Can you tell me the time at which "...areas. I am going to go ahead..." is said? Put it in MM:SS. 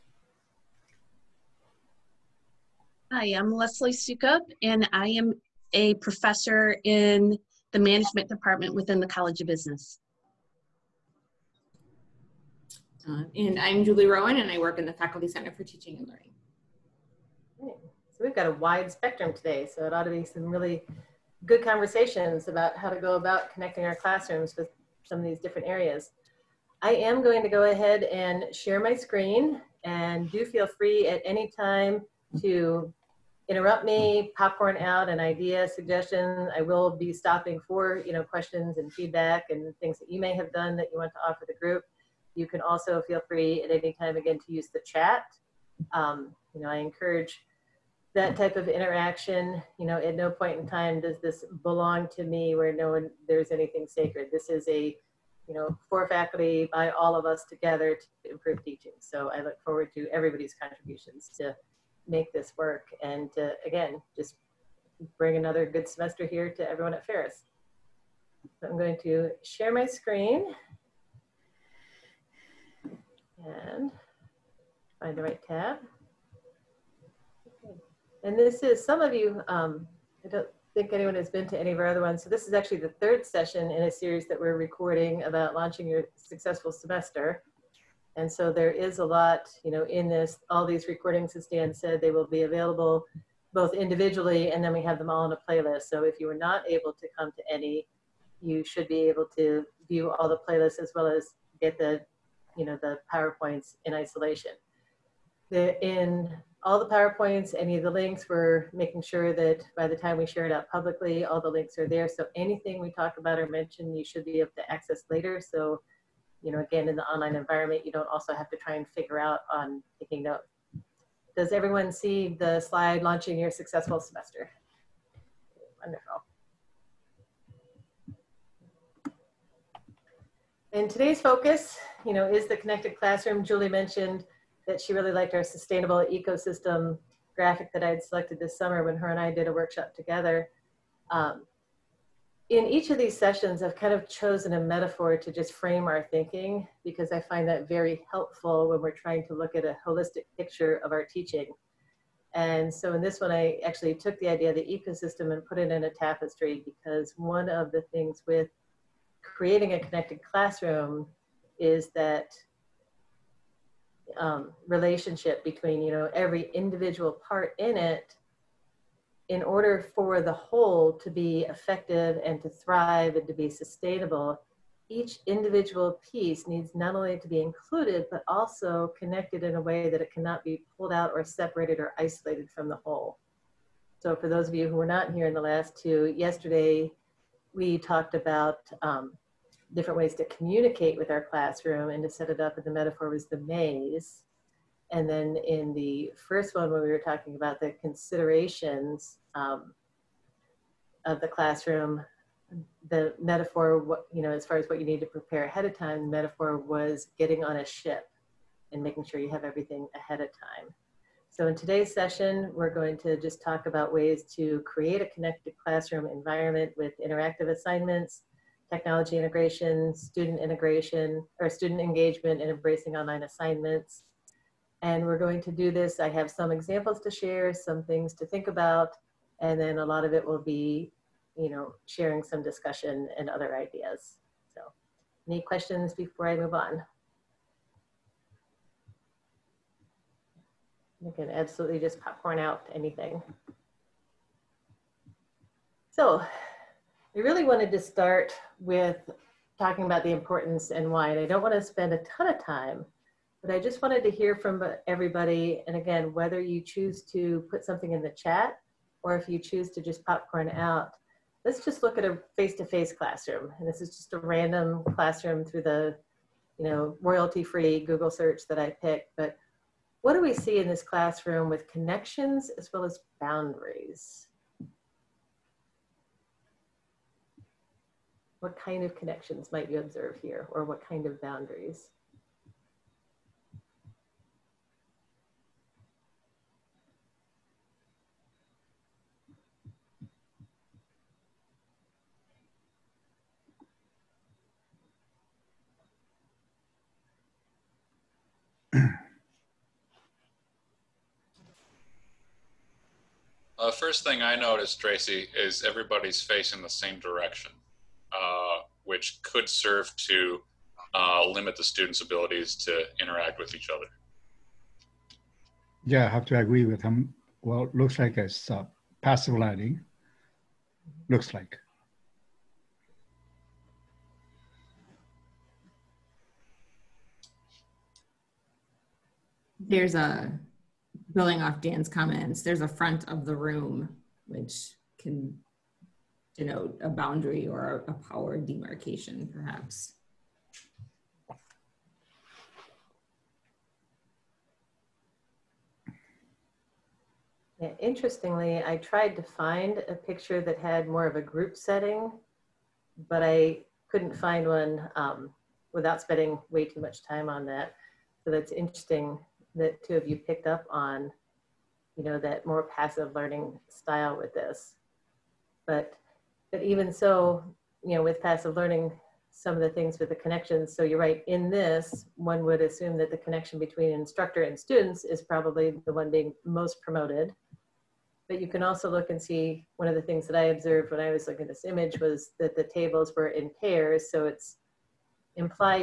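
00:25.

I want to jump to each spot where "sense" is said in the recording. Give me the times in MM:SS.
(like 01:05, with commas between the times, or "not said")
not said.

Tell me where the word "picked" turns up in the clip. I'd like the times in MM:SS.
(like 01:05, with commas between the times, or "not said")
04:28, 06:00.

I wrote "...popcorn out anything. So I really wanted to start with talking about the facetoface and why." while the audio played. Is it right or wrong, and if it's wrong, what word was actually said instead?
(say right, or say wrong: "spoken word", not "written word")
wrong: "importance", not "facetoface".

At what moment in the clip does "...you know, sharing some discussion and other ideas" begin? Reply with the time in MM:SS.
03:51.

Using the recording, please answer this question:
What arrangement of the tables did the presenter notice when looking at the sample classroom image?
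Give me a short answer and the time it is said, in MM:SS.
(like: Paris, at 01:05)
In pairs, at 06:23.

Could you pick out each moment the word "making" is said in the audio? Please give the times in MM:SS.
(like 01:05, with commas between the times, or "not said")
01:48, 03:28.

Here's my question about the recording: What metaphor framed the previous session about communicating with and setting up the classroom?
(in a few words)
The maze.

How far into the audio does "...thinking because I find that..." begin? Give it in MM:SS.
02:26.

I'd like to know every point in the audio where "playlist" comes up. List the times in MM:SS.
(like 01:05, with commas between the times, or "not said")
01:35, 01:40.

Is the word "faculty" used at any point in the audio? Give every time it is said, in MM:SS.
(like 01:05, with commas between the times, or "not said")
00:14, 00:56.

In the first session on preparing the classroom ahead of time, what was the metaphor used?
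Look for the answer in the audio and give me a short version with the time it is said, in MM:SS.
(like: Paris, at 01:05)
Getting on a ship, at 03:27.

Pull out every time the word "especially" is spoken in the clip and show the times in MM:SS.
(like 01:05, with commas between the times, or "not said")
not said.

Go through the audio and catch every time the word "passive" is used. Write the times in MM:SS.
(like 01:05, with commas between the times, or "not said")
05:19, 06:02, 06:08.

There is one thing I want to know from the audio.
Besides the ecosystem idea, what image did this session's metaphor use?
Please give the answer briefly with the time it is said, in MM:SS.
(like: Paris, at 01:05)
A tapestry, at 02:35.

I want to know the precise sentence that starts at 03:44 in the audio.
And we're going to do this.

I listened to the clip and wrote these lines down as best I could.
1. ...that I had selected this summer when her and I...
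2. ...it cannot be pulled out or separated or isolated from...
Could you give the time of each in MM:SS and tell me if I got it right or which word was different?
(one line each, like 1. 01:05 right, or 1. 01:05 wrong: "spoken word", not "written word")
1. 02:17 right
2. 03:00 right.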